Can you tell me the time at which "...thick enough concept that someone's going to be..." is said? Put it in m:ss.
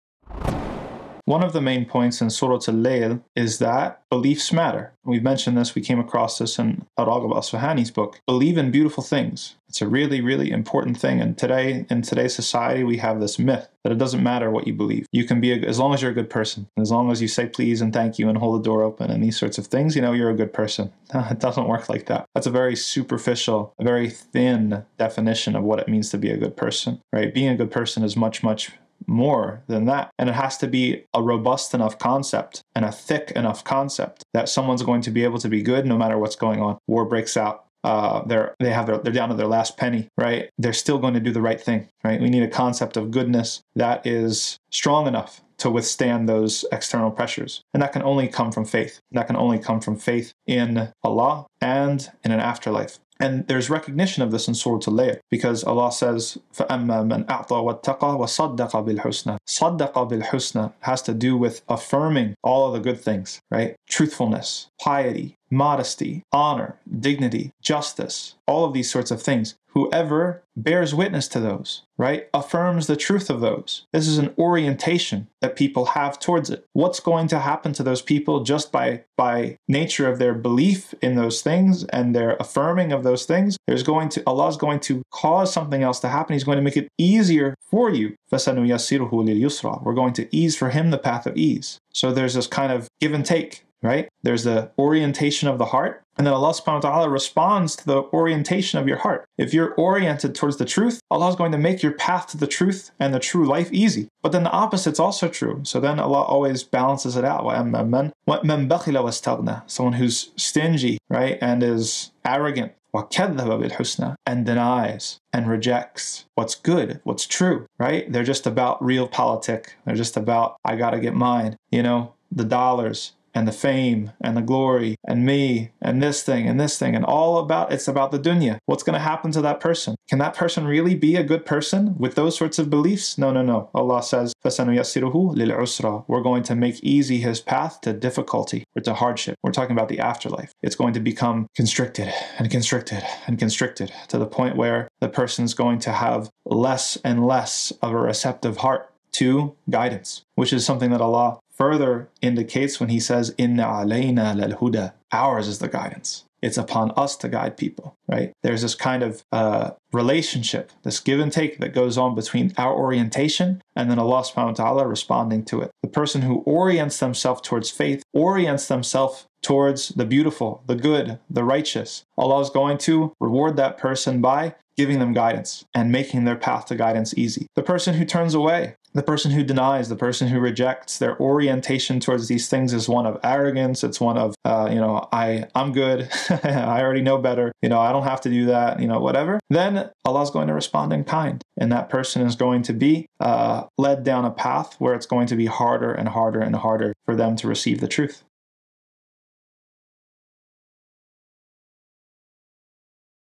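0:32.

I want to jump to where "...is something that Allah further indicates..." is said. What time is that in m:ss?
2:30.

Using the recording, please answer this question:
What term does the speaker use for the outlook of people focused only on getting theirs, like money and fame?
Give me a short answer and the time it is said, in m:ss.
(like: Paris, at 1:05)
realpolitik, at 1:58.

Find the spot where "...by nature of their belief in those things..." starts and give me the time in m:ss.
1:19.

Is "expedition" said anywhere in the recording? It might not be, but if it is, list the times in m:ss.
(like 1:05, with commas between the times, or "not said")
not said.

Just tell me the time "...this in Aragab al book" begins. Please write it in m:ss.
0:06.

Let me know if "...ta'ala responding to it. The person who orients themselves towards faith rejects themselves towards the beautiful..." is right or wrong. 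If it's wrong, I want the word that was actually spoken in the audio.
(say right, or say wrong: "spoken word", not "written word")
wrong: "orients", not "rejects".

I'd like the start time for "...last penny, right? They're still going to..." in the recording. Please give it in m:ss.
0:39.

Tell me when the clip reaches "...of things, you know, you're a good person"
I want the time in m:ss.
0:19.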